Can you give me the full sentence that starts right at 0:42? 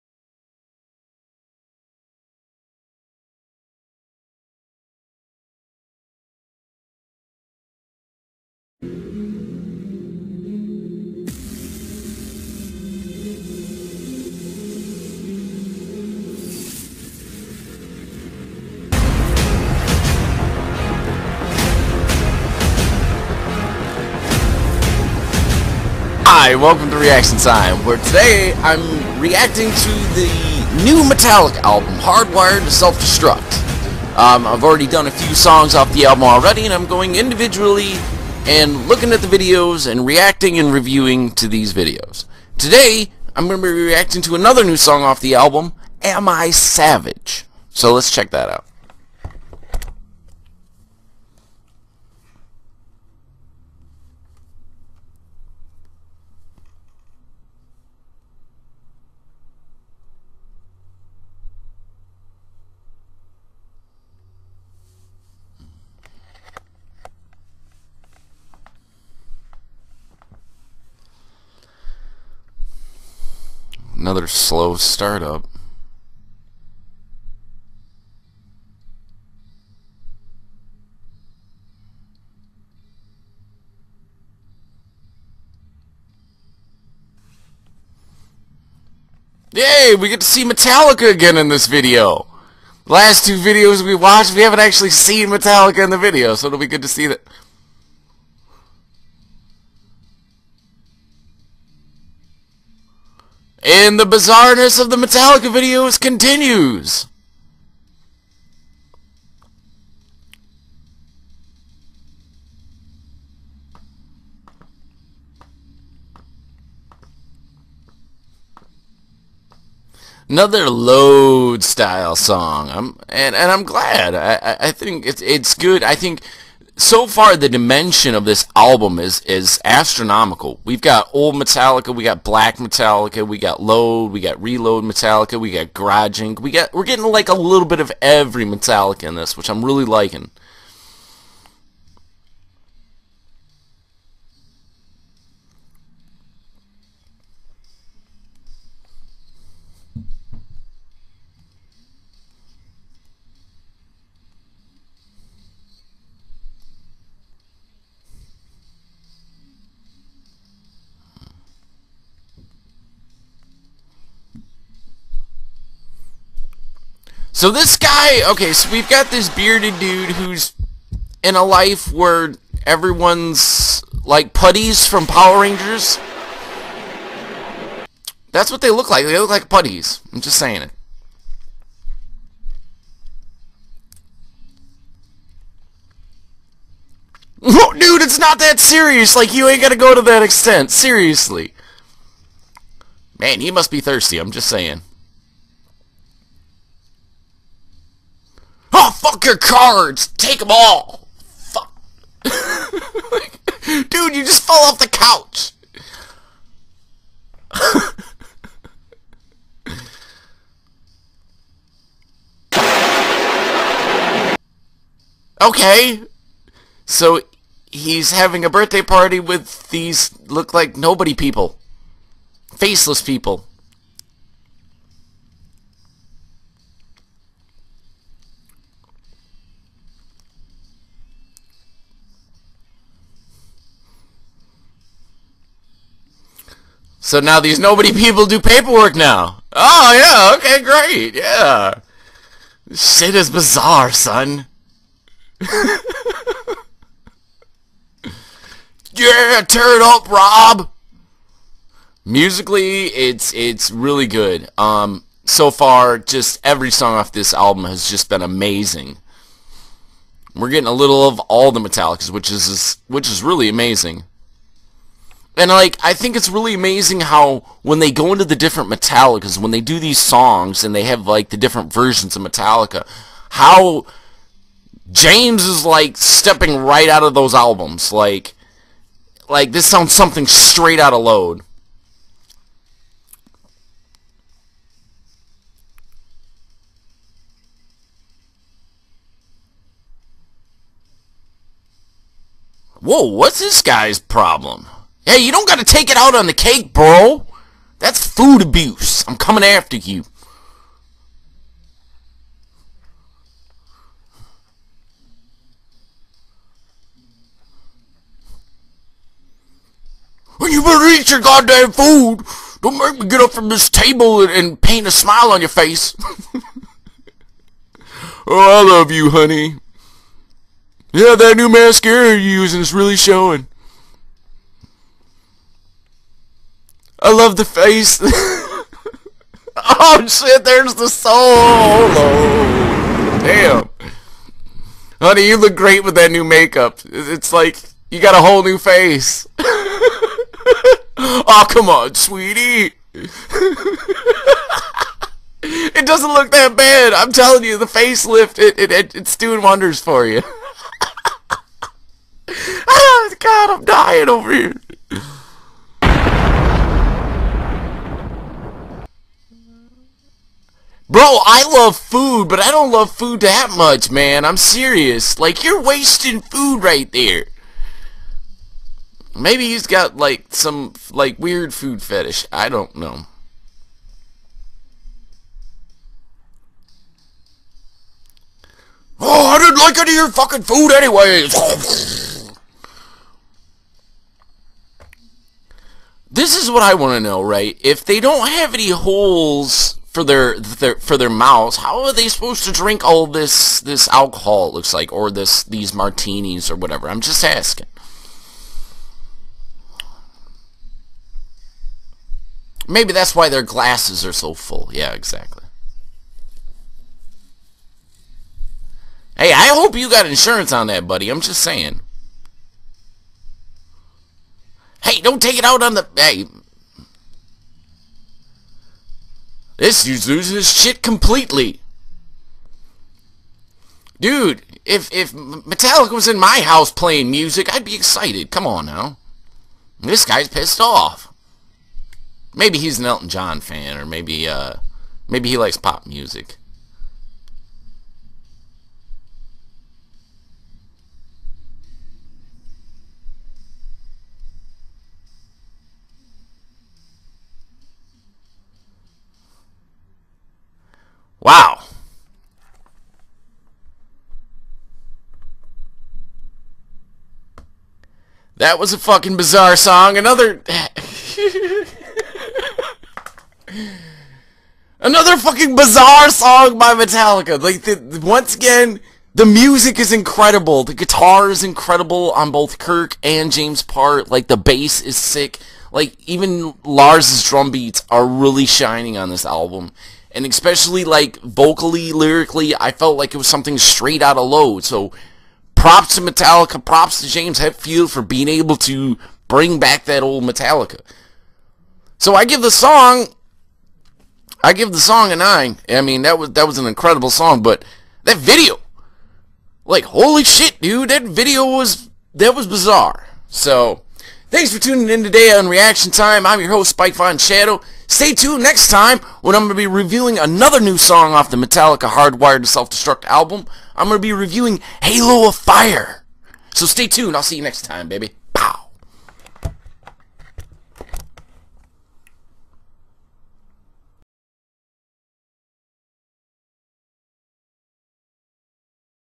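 Today, I'm going to be reacting to another new song off the album, Am I Savage?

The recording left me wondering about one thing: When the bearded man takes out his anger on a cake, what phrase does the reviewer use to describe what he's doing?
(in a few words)
food abuse.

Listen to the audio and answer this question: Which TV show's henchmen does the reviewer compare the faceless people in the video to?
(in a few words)
Power Rangers.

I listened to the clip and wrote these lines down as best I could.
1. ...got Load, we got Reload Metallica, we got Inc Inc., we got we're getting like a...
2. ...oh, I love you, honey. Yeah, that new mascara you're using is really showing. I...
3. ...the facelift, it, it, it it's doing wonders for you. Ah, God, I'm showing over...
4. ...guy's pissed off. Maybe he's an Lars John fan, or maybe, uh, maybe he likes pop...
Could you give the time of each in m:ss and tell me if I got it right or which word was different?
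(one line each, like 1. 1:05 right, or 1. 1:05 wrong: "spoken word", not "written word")
1. 2:13 wrong: "Garage", not "Inc"
2. 5:18 right
3. 5:47 wrong: "dying", not "showing"
4. 7:10 wrong: "Elton", not "Lars".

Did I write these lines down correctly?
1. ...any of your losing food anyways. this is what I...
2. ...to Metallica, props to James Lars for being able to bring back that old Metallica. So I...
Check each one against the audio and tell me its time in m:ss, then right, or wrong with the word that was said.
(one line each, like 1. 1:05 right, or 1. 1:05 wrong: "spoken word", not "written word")
1. 6:19 wrong: "fucking", not "losing"
2. 8:05 wrong: "Hetfield", not "Lars".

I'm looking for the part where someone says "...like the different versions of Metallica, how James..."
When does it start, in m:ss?
4:31.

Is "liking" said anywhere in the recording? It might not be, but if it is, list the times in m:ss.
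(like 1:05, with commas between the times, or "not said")
2:19.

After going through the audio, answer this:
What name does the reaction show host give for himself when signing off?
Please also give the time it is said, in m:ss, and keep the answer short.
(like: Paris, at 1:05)
Spyke VonShadow, at 8:26.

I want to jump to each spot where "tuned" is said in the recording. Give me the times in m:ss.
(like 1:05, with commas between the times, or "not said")
8:28, 8:36.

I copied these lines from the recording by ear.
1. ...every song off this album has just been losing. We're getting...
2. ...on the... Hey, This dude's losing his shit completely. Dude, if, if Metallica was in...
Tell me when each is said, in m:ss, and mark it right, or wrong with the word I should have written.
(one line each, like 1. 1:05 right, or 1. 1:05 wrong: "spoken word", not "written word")
1. 4:16 wrong: "amazing", not "losing"
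2. 6:55 right.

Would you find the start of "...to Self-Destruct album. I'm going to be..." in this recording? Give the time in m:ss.
8:32.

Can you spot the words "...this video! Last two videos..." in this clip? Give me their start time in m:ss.
1:31.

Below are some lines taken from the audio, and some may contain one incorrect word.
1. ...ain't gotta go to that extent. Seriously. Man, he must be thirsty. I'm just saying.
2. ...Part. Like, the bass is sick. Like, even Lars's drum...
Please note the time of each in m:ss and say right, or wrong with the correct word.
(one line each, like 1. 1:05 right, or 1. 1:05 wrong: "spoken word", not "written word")
1. 3:09 right
2. 7:53 right.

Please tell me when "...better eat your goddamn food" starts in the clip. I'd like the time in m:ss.
5:10.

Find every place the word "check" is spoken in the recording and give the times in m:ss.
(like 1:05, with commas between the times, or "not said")
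0:48.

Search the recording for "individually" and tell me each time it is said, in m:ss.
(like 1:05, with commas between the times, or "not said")
0:37.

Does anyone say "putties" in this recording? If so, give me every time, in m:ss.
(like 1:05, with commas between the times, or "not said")
2:54, 2:59.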